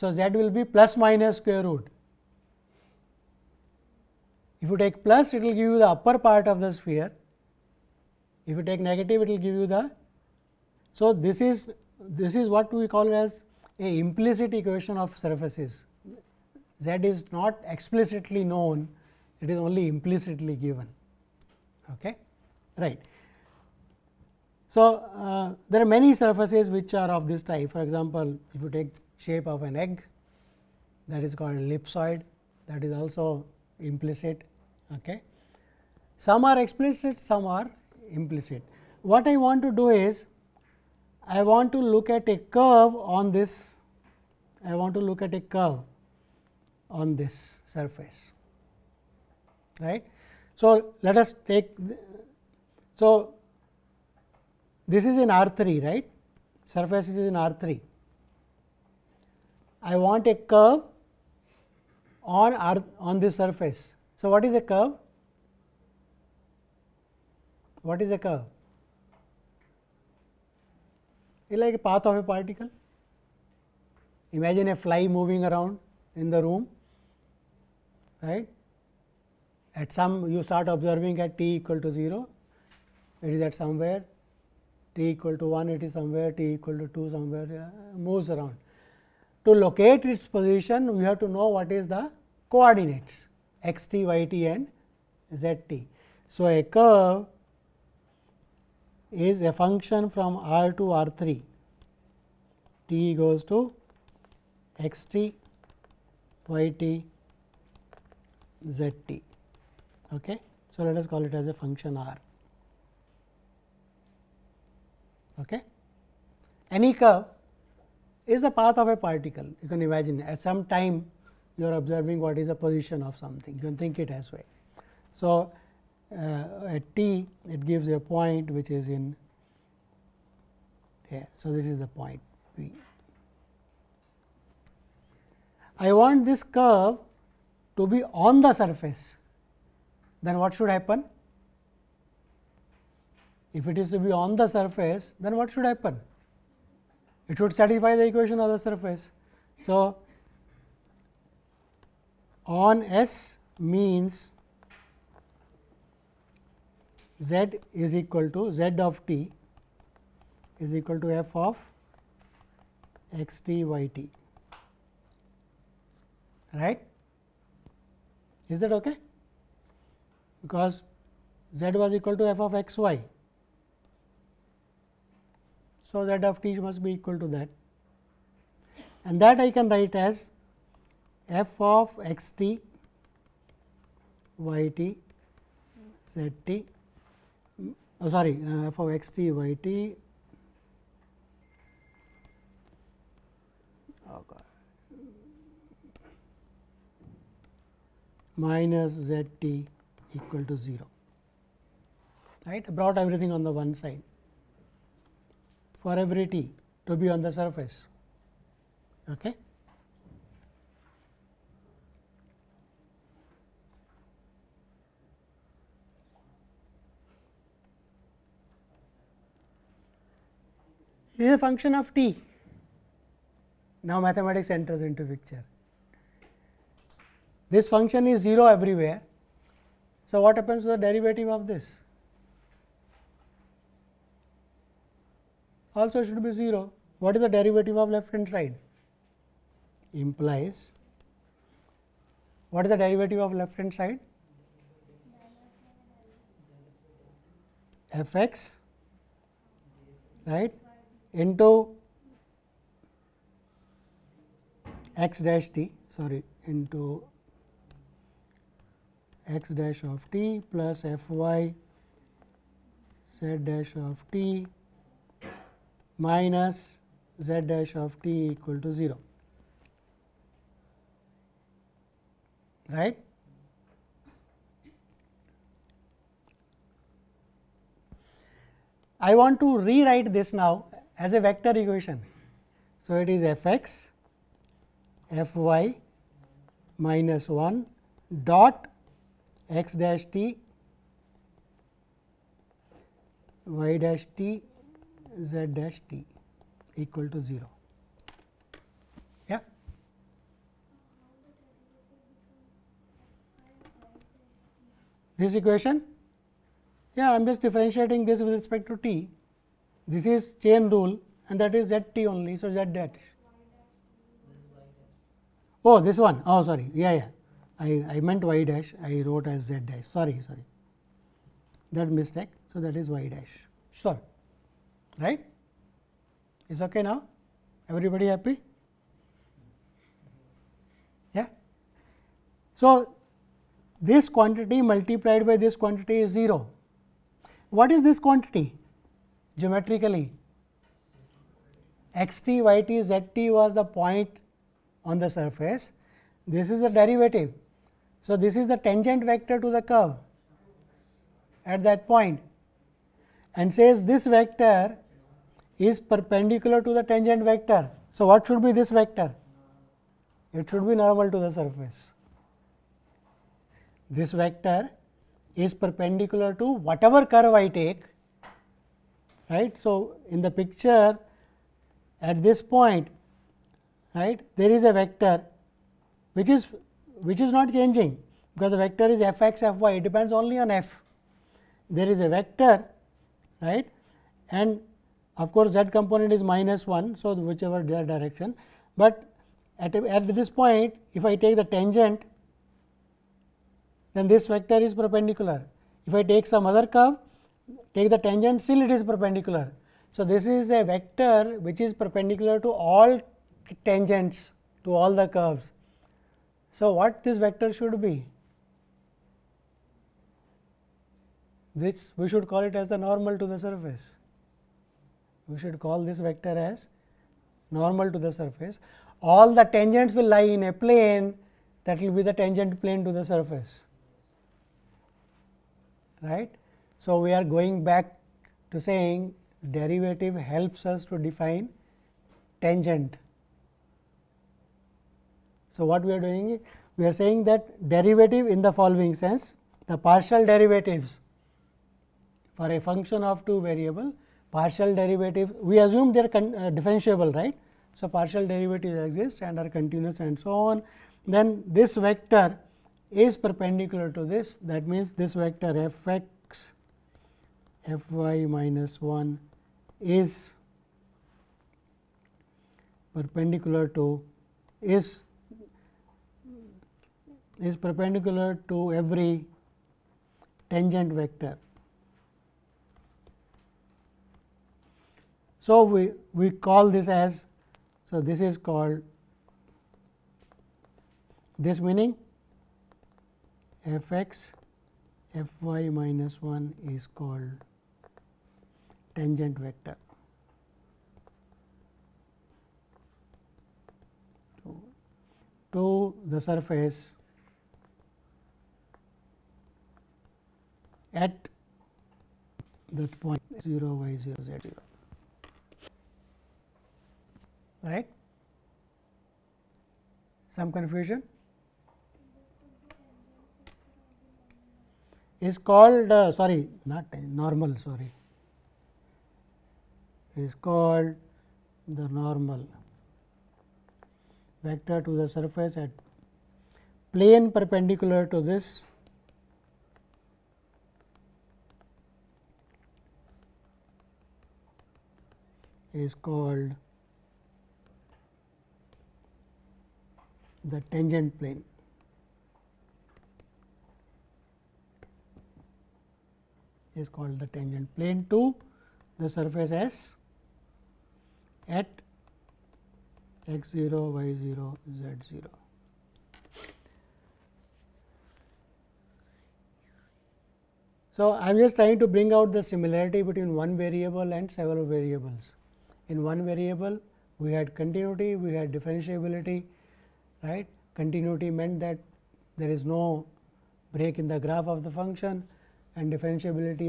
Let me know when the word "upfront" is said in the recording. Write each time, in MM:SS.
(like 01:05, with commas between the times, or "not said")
not said.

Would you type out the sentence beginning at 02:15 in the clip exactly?
I want this curve to be on the surface.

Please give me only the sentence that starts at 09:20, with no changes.
So, I am just trying to bring out the similarity between one variable and several variables.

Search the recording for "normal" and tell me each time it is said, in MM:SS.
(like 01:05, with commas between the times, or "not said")
06:00, 06:52, 06:57, 08:36, 08:41.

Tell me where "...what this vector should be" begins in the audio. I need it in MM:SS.
06:46.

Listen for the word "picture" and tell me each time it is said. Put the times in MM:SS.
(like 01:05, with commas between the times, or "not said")
03:45, 06:10.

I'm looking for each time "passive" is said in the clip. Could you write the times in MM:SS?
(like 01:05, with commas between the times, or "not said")
not said.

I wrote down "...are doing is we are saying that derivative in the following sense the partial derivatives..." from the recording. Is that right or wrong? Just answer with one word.
right.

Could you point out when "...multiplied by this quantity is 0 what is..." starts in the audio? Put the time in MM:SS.
05:34.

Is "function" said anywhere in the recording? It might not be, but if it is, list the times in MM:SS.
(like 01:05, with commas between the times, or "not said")
01:39, 01:51, 03:41, 03:47, 07:22, 09:34.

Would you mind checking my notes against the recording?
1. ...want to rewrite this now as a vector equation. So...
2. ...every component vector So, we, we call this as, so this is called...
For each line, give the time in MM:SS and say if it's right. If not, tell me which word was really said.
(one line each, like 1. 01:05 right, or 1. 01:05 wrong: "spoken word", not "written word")
1. 04:39 right
2. 07:48 wrong: "tangent", not "component".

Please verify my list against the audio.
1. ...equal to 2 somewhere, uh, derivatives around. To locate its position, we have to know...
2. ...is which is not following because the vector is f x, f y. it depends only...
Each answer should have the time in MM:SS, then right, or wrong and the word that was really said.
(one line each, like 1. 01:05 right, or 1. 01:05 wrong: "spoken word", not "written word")
1. 01:26 wrong: "moves", not "derivatives"
2. 06:16 wrong: "changing", not "following".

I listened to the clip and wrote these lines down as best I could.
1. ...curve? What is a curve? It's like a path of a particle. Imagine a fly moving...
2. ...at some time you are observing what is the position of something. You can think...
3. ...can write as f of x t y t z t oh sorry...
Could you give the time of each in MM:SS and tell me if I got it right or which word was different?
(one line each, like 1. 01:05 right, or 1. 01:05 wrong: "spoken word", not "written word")
1. 01:04 right
2. 02:00 right
3. 02:59 right.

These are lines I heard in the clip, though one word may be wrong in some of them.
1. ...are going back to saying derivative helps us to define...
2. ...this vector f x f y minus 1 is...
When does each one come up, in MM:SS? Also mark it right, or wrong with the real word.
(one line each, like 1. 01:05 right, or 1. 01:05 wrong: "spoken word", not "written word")
1. 07:07 right
2. 07:35 right.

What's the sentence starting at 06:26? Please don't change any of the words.
So, whichever direction, but at, a, at this point if I take the tangent then this vector is perpendicular.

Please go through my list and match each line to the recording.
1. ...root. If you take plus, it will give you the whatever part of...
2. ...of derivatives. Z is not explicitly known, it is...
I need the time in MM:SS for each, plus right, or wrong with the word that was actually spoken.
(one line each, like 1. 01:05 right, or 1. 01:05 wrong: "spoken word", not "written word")
1. 00:01 wrong: "upper", not "whatever"
2. 00:14 wrong: "surfaces", not "derivatives".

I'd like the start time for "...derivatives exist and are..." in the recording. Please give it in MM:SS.
07:28.